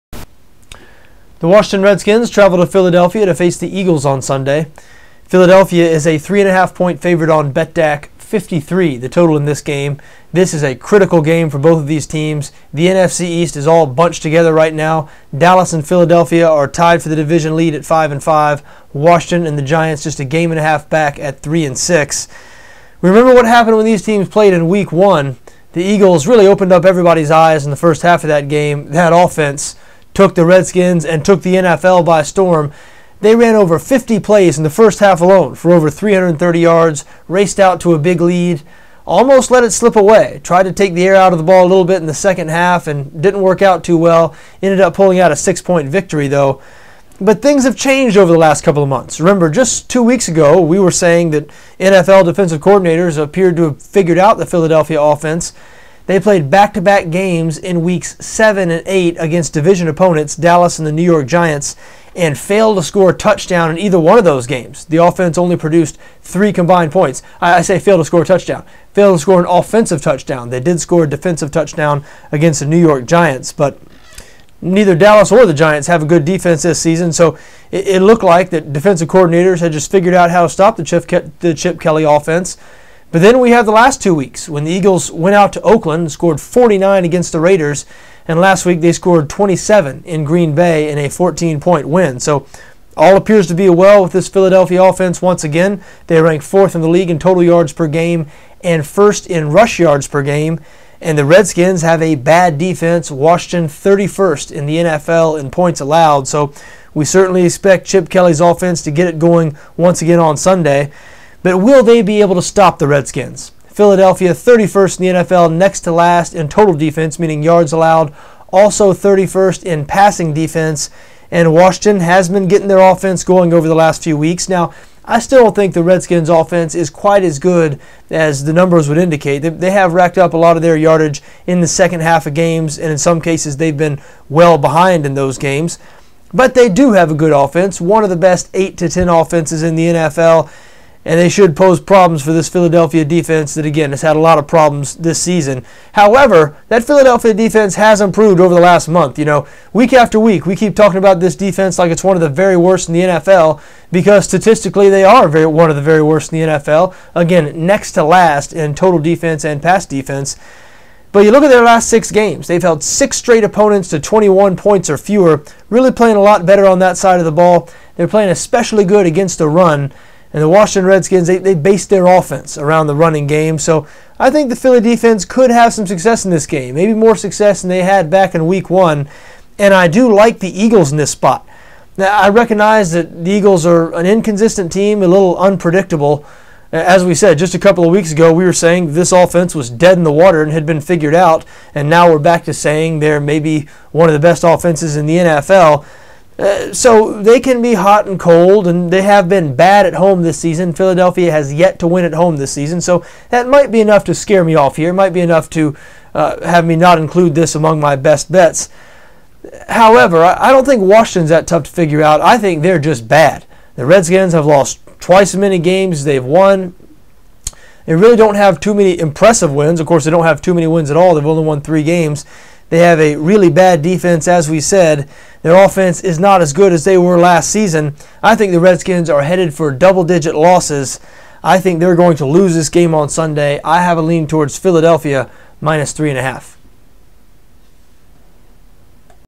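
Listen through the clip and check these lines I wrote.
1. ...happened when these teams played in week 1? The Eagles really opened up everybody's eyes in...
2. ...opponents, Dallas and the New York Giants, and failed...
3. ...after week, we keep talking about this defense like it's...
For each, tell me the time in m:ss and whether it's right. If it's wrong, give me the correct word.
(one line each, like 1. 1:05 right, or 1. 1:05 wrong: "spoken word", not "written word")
1. 0:23 right
2. 0:59 right
3. 2:29 right.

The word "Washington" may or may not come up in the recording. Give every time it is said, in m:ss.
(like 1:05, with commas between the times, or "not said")
0:01, 0:18, 1:43, 2:01, 2:50, 3:30.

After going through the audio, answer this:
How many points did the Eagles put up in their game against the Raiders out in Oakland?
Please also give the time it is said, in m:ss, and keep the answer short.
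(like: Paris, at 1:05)
49, at 1:26.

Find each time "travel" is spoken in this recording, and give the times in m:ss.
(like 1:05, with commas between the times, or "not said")
0:02.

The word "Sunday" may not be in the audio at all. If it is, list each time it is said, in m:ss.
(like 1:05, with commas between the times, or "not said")
0:04, 1:50, 3:53.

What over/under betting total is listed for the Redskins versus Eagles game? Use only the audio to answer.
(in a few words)
53.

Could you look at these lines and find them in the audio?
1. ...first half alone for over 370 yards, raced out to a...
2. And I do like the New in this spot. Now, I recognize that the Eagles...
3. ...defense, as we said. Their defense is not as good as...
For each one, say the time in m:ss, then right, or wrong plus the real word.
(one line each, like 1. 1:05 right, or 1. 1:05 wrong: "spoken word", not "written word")
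1. 0:34 wrong: "330", not "370"
2. 2:59 wrong: "Eagles", not "New"
3. 3:43 wrong: "offense", not "defense".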